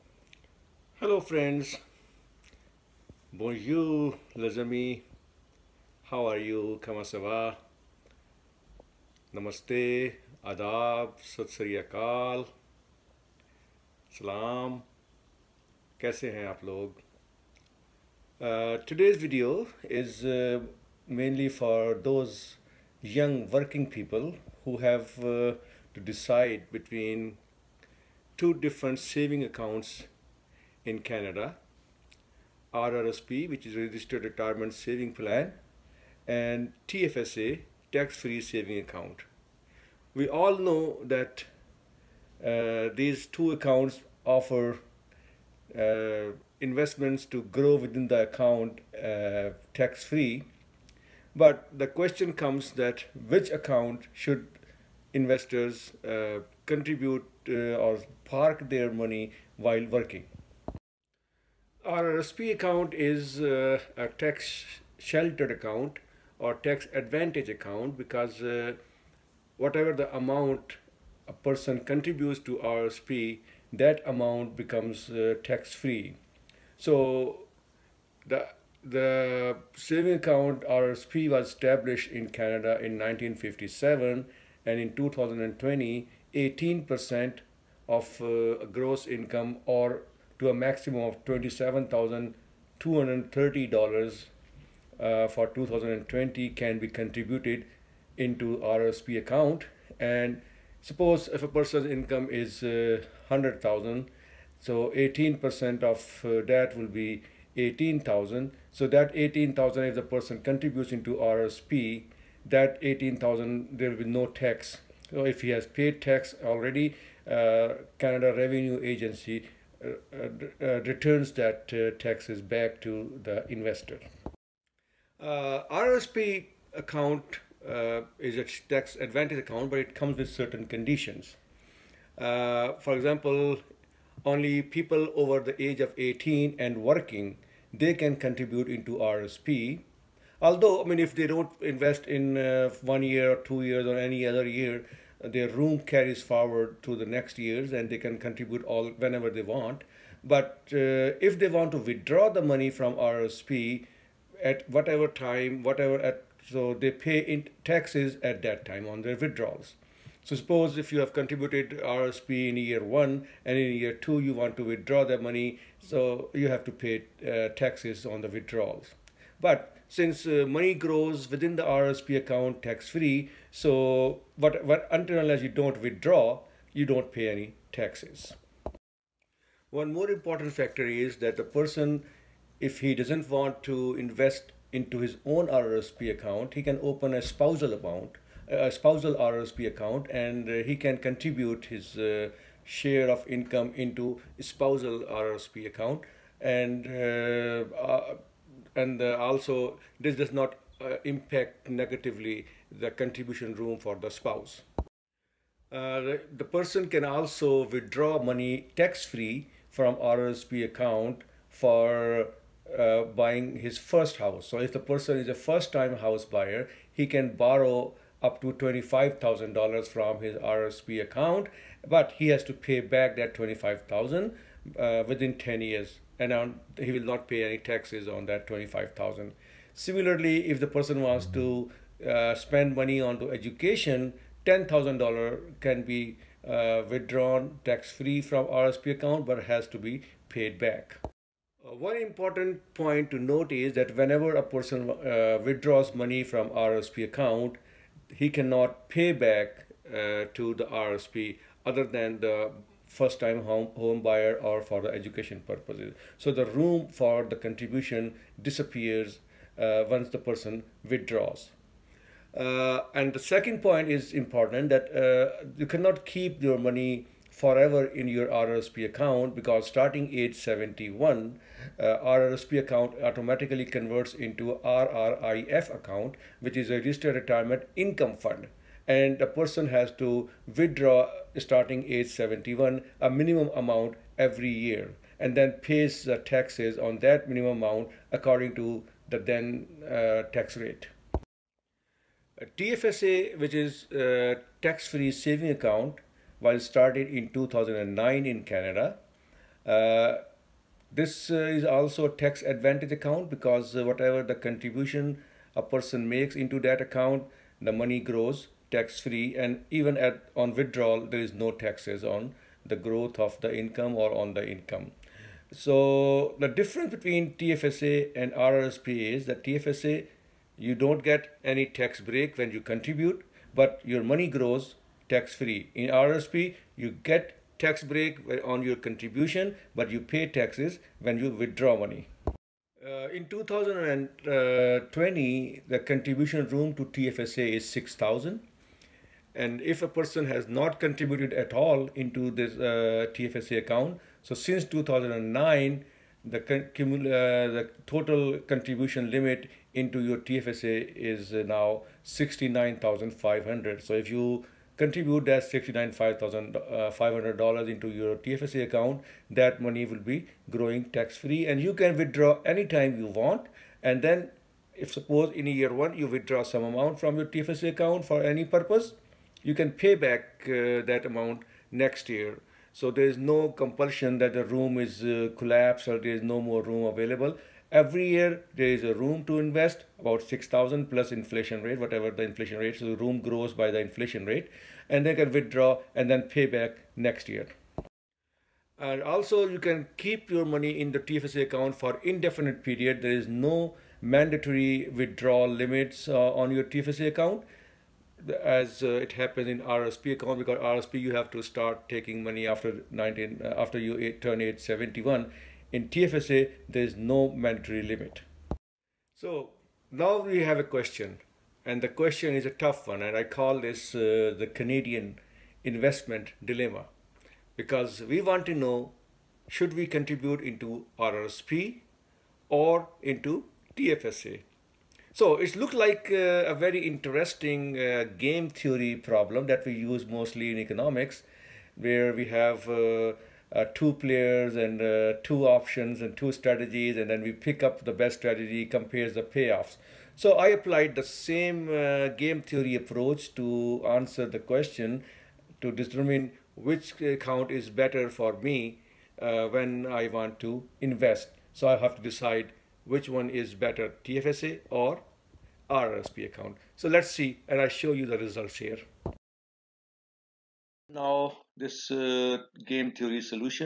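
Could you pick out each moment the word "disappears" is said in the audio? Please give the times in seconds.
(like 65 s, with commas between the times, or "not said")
258 s.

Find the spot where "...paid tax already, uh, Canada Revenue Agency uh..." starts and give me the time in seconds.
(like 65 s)
115 s.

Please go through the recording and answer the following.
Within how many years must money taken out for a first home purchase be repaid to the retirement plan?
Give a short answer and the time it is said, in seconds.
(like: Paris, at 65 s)
10 years, at 225 s.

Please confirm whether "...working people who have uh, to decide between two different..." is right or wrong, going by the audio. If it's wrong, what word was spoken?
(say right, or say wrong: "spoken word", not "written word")
right.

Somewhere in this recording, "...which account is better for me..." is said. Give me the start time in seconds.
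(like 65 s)
446 s.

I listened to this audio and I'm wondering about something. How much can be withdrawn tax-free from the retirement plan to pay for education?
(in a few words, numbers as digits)
$10,000.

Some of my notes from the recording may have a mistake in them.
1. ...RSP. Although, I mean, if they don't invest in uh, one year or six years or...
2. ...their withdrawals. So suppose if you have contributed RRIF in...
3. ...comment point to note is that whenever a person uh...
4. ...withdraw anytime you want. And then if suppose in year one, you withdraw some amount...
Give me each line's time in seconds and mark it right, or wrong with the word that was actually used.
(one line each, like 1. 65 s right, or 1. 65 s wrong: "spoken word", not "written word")
1. 138 s wrong: "two", not "six"
2. 159 s wrong: "RSP", not "RRIF"
3. 241 s wrong: "important", not "comment"
4. 361 s right.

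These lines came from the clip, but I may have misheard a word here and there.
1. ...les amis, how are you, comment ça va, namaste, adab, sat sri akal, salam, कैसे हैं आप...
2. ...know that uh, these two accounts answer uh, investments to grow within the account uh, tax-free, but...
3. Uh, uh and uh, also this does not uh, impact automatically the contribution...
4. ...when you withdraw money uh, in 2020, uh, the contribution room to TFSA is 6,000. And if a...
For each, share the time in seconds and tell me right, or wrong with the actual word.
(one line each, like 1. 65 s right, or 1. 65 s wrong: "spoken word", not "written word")
1. 4 s right
2. 40 s wrong: "offer", not "answer"
3. 196 s wrong: "negatively", not "automatically"
4. 330 s right.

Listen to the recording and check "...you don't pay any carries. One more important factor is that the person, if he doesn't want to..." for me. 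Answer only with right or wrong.
wrong.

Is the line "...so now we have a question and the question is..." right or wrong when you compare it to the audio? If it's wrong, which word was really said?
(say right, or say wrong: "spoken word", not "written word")
right.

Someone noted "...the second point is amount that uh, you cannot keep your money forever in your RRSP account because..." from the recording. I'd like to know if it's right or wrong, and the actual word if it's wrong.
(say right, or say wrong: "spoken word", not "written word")
wrong: "important", not "amount".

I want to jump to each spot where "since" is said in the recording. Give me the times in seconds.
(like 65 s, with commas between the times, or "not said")
169 s, 344 s.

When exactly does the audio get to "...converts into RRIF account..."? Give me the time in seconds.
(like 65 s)
273 s.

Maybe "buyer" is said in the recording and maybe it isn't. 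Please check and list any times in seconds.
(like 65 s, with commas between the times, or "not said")
216 s, 254 s.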